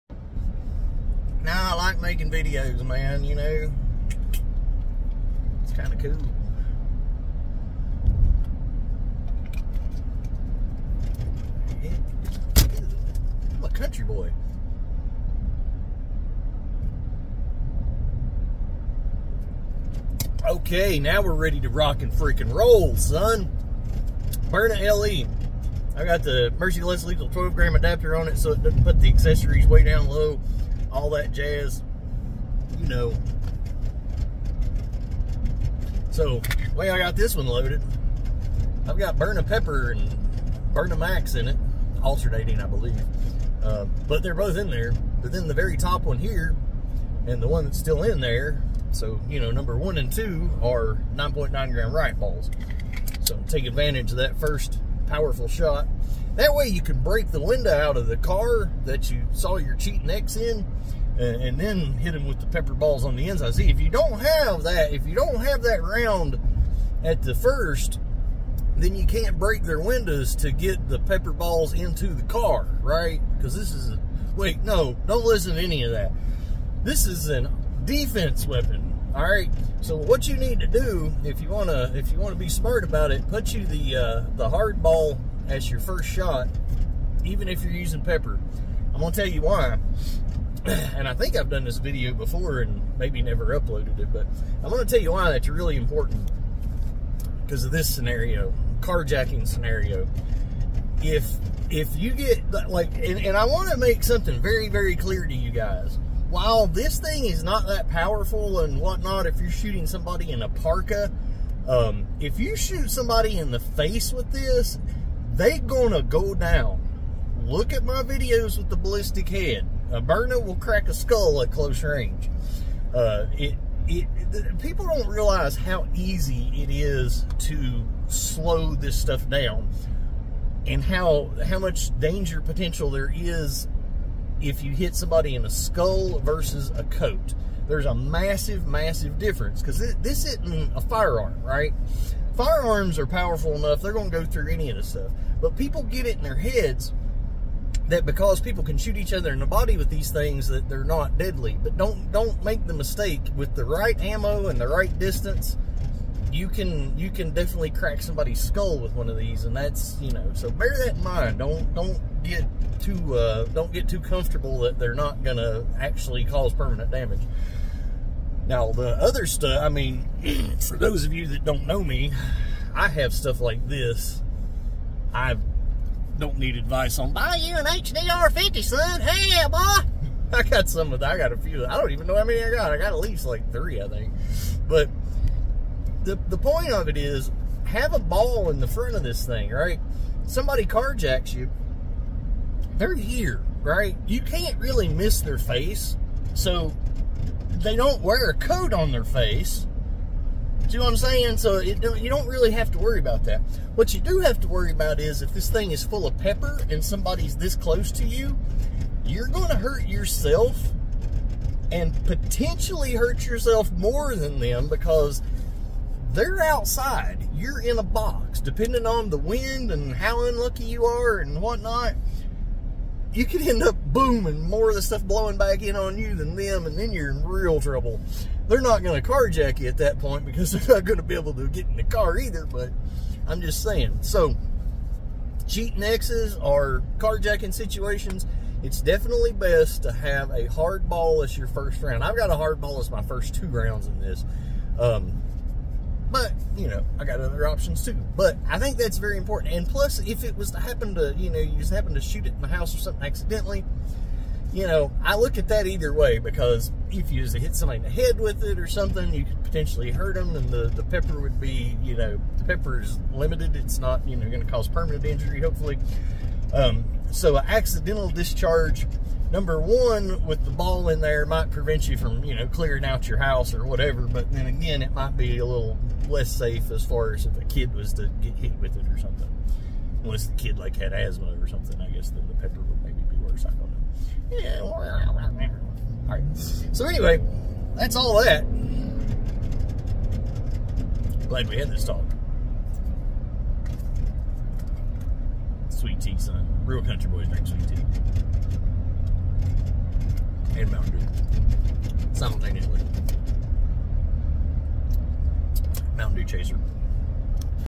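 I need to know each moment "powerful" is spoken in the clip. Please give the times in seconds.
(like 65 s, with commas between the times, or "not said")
55 s, 107 s, 143 s.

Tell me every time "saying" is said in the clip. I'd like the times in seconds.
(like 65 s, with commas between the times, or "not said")
200 s, 233 s.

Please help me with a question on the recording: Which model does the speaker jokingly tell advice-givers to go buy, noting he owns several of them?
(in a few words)
HDR50.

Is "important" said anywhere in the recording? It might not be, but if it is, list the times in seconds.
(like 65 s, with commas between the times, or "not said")
95 s, 249 s.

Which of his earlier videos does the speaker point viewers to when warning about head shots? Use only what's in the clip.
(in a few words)
the ballistic head.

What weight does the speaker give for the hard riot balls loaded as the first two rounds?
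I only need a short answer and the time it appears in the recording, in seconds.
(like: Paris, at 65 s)
9.9 gram, at 51 s.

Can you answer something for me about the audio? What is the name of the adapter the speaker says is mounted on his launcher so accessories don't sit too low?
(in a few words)
Lethal 12 gram adapter.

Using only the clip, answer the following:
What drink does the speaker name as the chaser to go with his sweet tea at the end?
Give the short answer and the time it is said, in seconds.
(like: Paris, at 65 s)
Mountain Dew, at 305 s.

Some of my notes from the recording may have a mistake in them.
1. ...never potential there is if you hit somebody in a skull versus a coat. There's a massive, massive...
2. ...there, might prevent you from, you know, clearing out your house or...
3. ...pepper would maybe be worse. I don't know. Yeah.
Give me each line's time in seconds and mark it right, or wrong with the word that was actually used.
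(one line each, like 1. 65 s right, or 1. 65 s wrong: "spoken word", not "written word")
1. 131 s wrong: "danger", not "never"
2. 271 s right
3. 282 s right.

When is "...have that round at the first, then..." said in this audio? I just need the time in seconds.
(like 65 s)
65 s.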